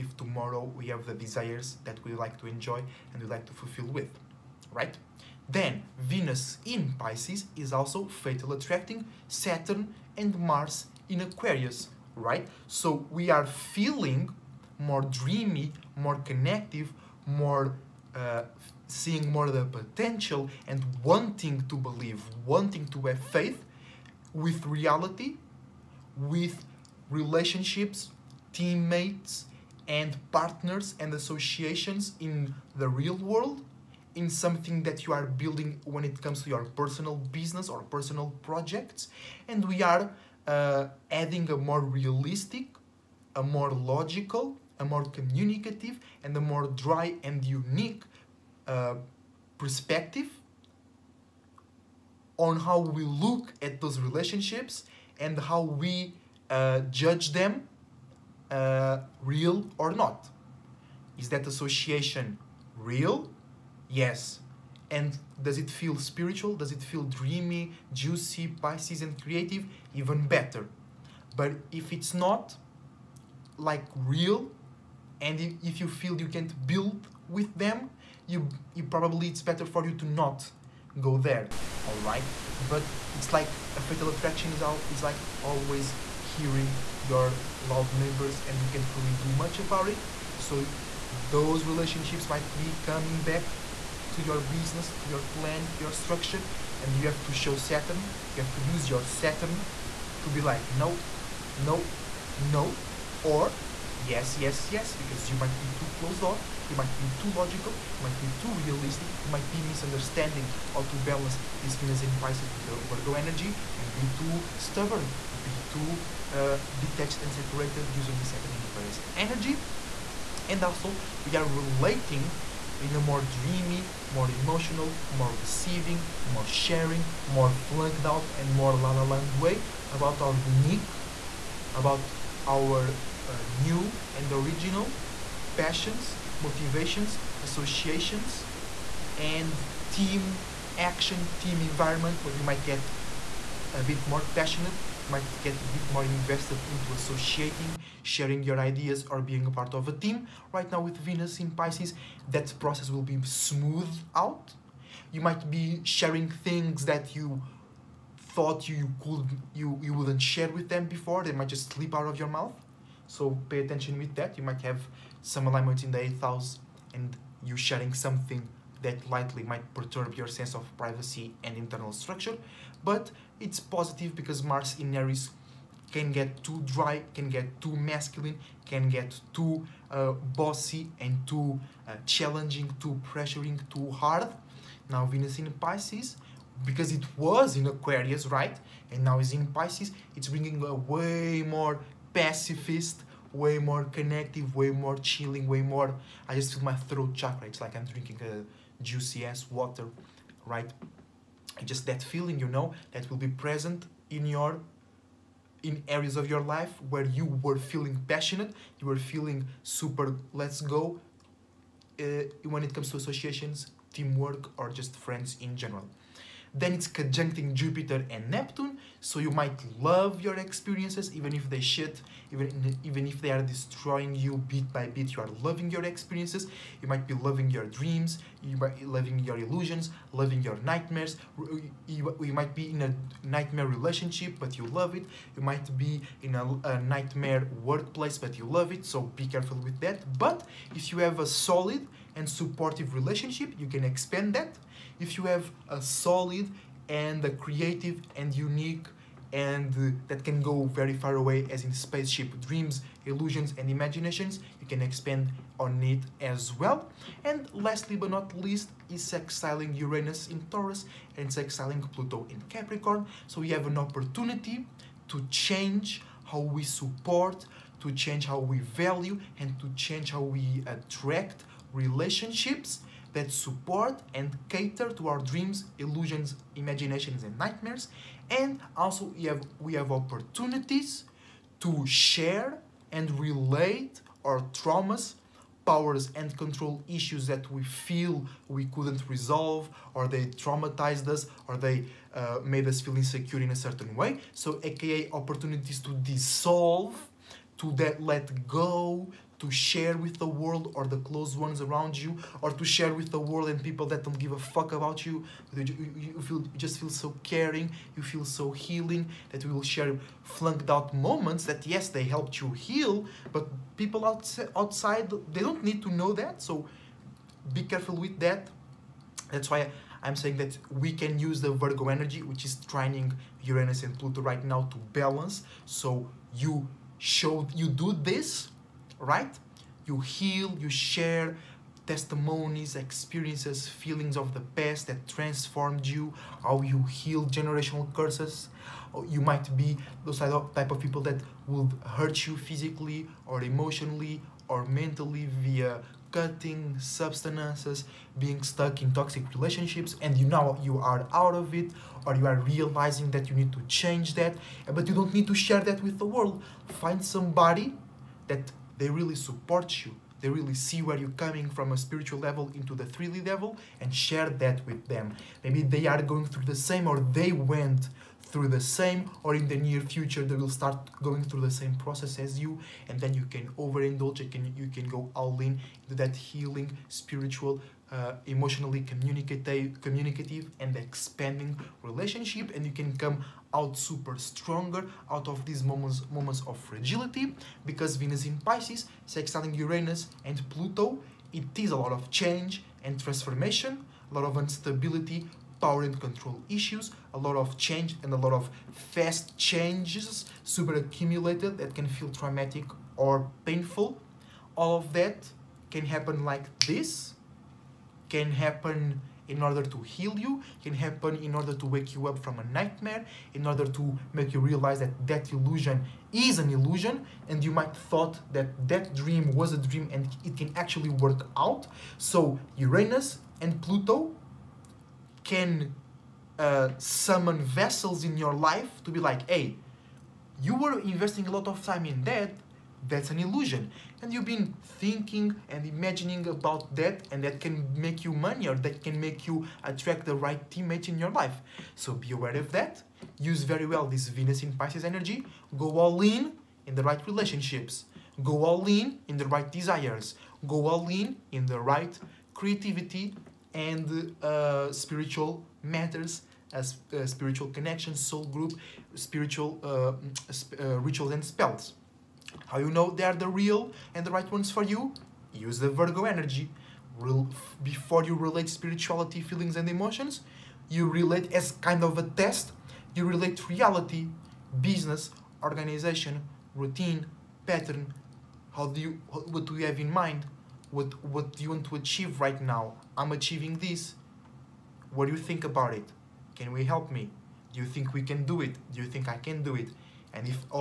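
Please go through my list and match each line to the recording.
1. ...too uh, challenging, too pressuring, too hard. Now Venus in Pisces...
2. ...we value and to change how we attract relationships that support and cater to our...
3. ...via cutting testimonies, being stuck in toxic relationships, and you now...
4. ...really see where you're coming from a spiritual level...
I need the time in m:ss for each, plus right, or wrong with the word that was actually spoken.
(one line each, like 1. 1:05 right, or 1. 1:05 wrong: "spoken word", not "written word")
1. 3:01 right
2. 4:28 right
3. 5:45 wrong: "substances", not "testimonies"
4. 6:00 right.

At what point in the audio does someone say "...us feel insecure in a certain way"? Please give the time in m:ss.
4:52.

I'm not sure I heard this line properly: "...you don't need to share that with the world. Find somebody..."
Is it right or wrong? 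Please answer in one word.
right.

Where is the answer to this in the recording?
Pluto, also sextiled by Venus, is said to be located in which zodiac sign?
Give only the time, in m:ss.
4:21.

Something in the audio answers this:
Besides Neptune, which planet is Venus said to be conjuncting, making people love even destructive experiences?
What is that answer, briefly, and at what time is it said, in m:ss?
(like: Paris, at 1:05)
Jupiter, at 3:37.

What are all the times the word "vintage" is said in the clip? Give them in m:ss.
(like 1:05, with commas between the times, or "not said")
not said.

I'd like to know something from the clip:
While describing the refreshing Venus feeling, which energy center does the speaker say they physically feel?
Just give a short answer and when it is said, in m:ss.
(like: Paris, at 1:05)
Throat chakra, at 3:16.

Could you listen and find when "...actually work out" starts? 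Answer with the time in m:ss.
7:00.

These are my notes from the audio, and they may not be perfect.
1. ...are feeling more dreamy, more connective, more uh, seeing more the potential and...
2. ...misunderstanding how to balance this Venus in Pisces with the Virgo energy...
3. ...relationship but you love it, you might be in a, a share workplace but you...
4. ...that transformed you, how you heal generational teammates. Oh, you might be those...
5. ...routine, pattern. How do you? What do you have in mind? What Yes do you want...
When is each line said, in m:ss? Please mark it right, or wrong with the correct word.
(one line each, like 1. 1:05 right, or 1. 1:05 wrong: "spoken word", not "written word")
1. 0:13 right
2. 1:49 right
3. 3:53 wrong: "nightmare", not "share"
4. 5:34 wrong: "curses", not "teammates"
5. 7:56 wrong: "What", not "Yes".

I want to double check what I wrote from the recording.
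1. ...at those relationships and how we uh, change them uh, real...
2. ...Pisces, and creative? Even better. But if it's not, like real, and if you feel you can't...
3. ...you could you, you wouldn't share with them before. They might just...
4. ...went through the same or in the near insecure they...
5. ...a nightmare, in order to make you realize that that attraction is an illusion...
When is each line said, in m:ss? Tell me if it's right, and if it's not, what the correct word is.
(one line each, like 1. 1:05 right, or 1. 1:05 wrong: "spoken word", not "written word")
1. 0:53 wrong: "judge", not "change"
2. 1:08 right
3. 2:38 right
4. 6:07 wrong: "future", not "insecure"
5. 6:52 wrong: "illusion", not "attraction".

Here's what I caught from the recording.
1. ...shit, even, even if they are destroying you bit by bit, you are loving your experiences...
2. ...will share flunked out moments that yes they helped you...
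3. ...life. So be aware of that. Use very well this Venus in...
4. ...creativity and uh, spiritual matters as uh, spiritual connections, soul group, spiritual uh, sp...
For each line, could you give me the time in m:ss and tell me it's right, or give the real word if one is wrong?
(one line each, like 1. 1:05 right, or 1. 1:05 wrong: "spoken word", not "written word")
1. 3:41 right
2. 5:09 right
3. 7:21 right
4. 7:32 right.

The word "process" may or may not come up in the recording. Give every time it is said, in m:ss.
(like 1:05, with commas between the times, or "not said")
2:32, 6:11.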